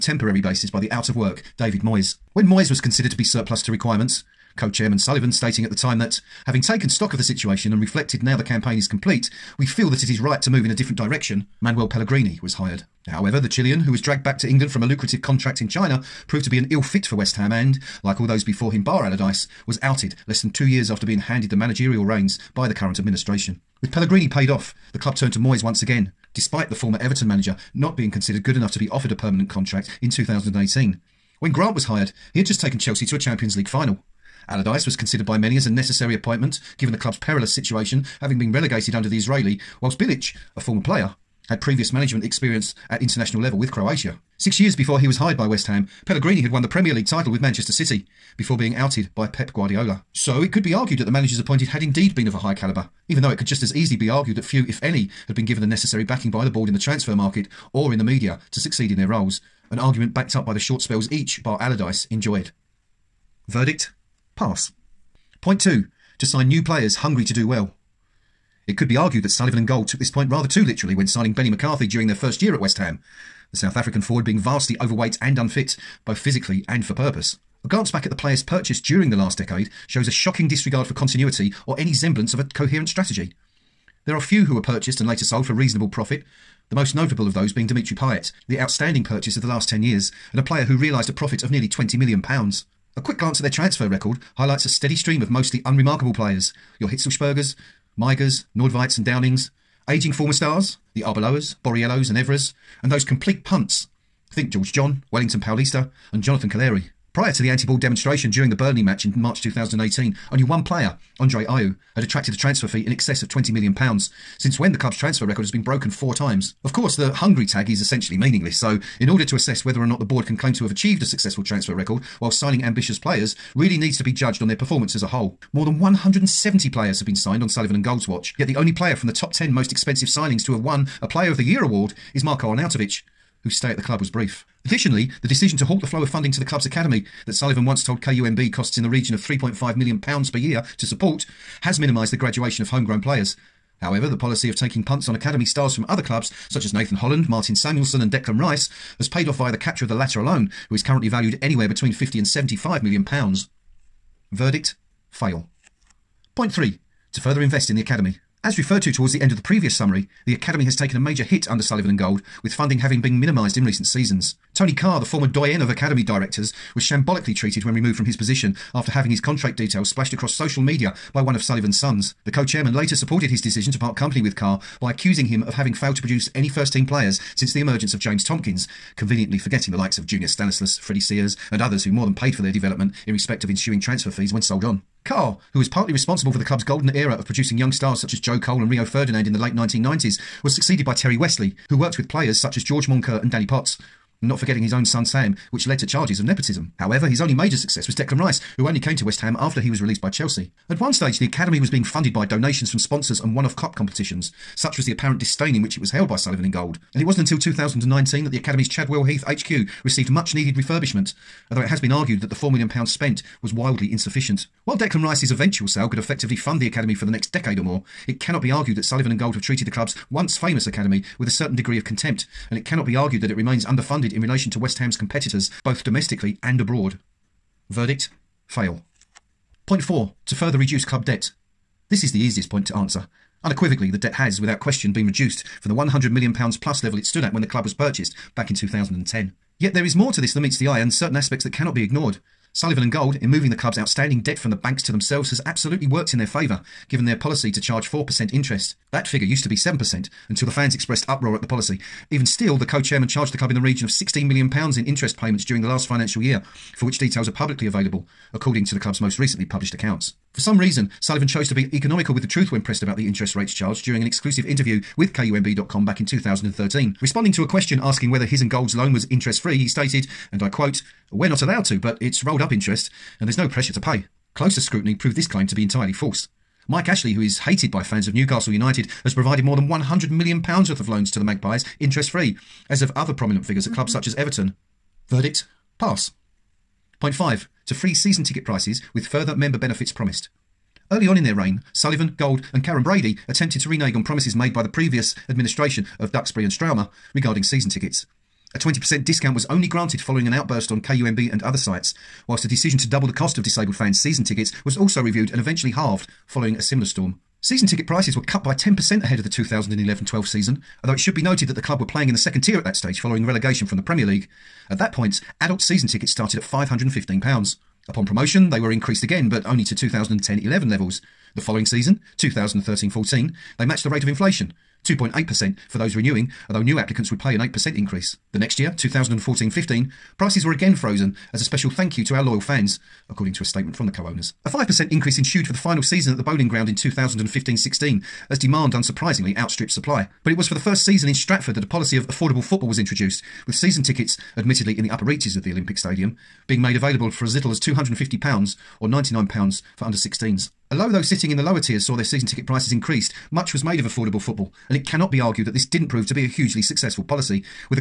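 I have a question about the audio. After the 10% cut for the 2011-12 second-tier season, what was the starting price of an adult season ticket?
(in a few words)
£515.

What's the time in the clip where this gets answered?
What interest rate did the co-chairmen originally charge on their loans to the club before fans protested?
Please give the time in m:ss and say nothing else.
4:09.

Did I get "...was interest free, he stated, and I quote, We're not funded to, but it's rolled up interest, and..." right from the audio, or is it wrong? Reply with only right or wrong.
wrong.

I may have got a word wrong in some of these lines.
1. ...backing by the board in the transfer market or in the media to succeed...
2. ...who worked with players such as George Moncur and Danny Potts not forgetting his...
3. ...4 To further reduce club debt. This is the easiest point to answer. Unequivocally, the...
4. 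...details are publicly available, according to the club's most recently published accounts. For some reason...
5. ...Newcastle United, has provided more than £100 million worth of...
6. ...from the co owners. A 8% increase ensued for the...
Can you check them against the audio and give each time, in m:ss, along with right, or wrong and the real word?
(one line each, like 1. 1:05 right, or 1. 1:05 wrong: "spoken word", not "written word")
1. 0:56 right
2. 3:11 right
3. 3:49 right
4. 4:16 right
5. 4:38 right
6. 5:33 wrong: "5", not "8".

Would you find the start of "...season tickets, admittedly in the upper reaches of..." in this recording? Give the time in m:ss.
5:43.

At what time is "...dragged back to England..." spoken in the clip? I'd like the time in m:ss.
0:14.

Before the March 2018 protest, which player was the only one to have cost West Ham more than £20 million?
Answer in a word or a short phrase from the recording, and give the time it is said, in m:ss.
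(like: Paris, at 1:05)
Andre Ayew, at 1:51.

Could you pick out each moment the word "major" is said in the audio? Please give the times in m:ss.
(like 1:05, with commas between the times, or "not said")
2:40, 3:17.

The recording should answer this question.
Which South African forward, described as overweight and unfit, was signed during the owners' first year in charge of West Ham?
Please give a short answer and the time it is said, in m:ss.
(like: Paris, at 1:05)
Benny McCarthy, at 1:11.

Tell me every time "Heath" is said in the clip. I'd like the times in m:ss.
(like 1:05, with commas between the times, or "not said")
3:29.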